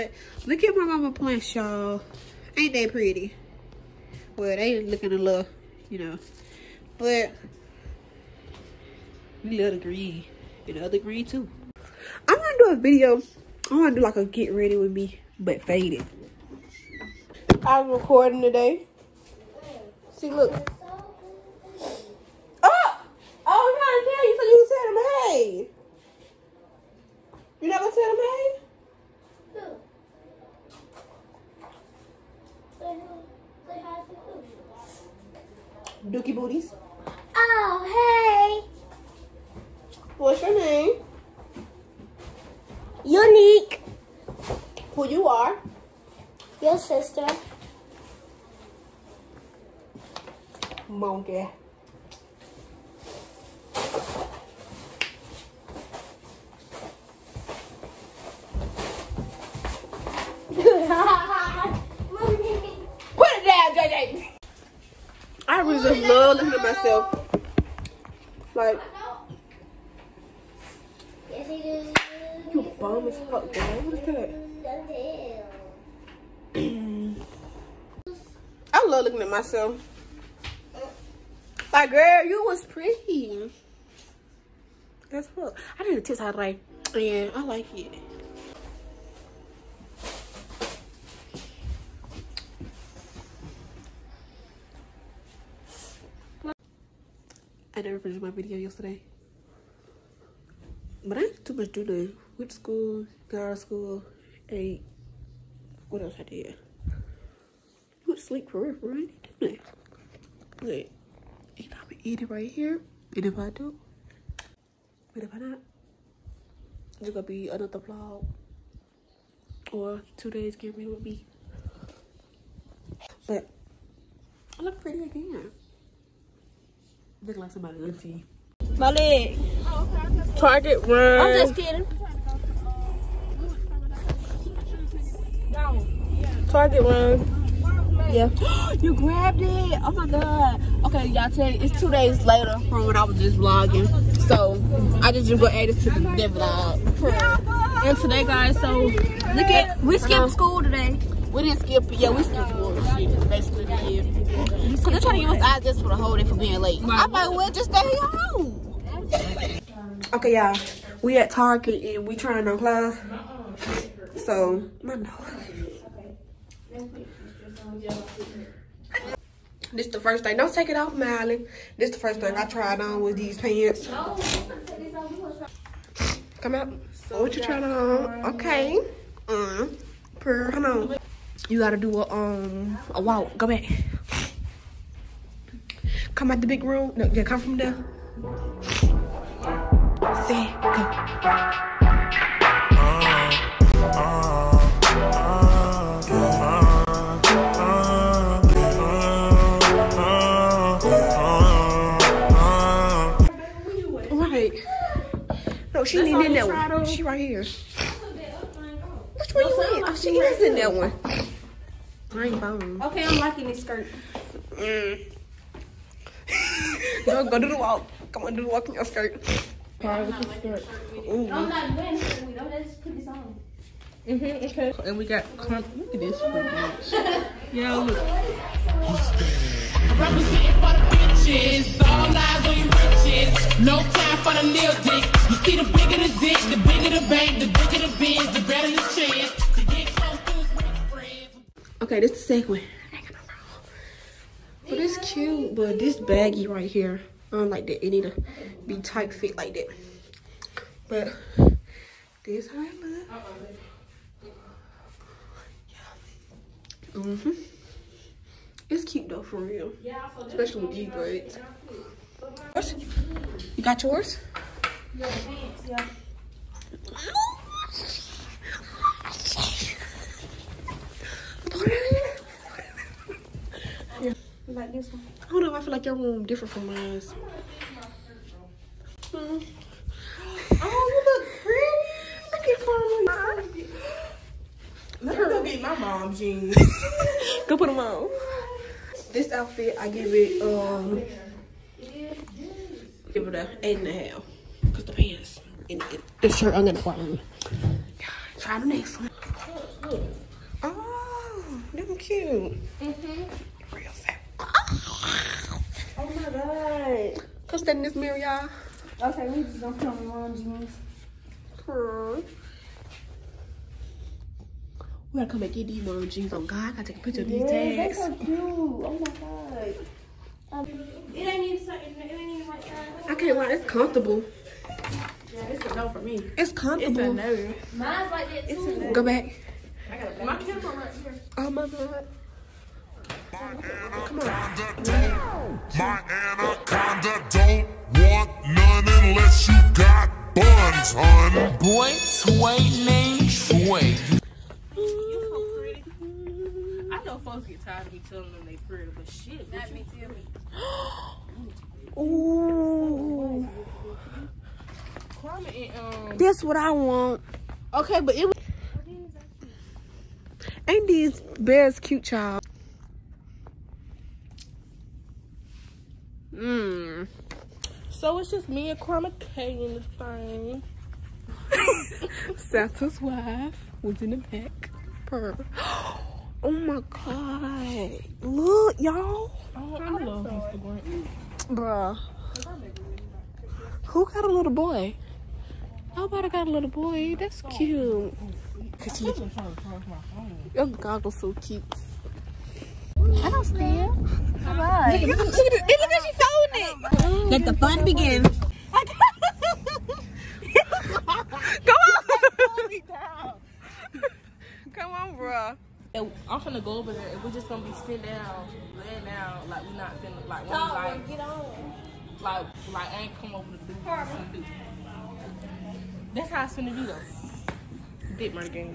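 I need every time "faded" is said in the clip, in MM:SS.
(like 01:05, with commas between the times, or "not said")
00:15.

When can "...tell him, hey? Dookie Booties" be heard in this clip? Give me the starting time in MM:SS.
00:36.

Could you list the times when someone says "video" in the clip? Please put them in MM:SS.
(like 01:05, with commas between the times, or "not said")
00:12, 01:38.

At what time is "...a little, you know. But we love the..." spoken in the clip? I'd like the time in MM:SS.
00:05.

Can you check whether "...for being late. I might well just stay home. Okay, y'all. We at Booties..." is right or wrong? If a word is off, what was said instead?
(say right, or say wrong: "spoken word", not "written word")
wrong: "Target", not "Booties".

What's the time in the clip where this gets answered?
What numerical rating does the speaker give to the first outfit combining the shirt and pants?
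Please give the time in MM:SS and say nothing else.
04:53.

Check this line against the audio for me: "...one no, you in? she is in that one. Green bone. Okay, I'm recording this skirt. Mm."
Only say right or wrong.
wrong.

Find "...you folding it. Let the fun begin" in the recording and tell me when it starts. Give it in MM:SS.
06:36.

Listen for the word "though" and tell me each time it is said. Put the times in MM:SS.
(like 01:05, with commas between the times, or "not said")
04:19, 06:56.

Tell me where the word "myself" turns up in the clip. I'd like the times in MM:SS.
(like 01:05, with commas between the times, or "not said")
01:06, 01:19.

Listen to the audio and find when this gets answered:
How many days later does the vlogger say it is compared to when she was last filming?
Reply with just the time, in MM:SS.
02:21.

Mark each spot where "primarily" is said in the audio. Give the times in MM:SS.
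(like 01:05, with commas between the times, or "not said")
not said.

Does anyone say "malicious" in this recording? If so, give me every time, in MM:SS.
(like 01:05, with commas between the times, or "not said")
not said.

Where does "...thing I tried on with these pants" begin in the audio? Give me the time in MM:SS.
02:52.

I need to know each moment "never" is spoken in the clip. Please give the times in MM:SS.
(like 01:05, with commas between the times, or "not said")
00:27, 01:37.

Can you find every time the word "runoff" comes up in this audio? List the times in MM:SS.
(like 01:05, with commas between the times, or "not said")
not said.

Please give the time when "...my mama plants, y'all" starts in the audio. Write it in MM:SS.
00:00.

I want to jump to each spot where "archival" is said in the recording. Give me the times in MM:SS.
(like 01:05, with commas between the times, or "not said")
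not said.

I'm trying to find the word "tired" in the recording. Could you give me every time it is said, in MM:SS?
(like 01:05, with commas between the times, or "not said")
05:47.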